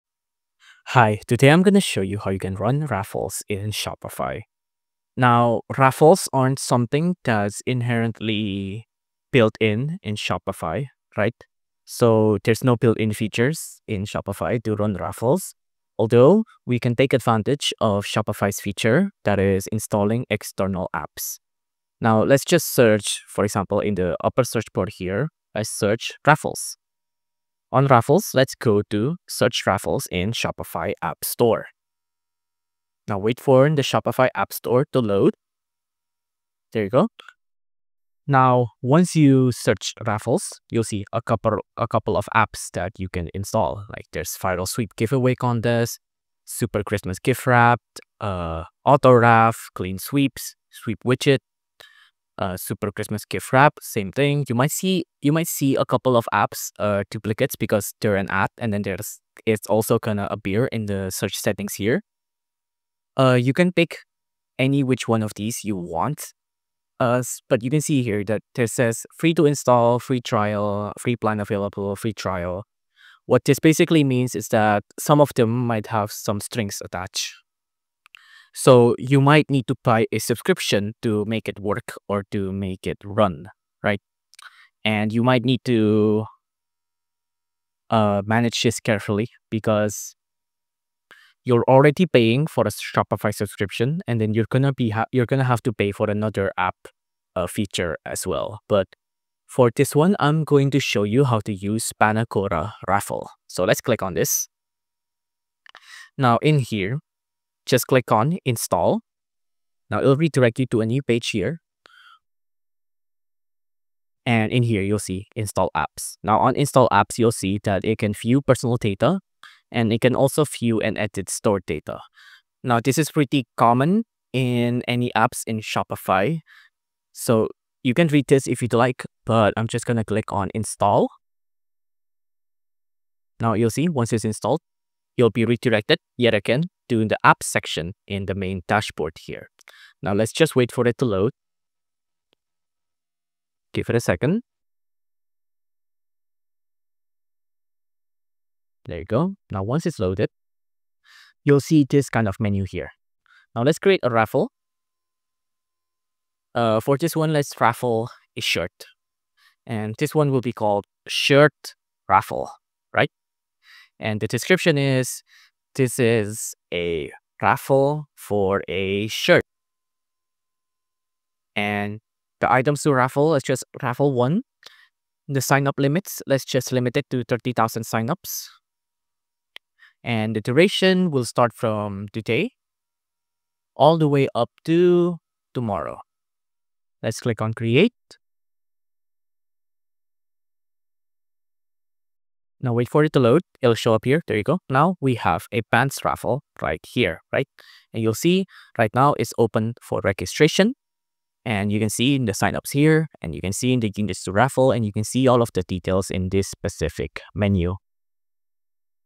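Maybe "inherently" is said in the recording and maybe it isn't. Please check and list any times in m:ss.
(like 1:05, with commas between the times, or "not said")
0:07.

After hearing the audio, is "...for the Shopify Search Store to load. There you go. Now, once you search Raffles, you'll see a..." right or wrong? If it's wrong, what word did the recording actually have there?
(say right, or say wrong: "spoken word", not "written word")
wrong: "App", not "Search".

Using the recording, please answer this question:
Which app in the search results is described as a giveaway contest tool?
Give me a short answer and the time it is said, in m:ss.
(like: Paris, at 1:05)
Viral Sweep, at 0:44.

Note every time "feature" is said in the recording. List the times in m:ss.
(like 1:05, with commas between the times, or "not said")
0:13, 0:18, 1:37.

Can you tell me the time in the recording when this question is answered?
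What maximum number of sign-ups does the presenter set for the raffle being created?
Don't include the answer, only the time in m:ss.
2:57.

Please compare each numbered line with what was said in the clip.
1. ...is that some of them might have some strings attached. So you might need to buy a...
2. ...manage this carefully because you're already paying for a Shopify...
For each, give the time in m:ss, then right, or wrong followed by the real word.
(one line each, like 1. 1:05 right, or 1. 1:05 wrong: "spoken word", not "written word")
1. 1:14 right
2. 1:28 right.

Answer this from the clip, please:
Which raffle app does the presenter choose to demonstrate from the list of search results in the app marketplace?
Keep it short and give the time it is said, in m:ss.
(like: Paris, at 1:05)
Panacora Raffle, at 1:41.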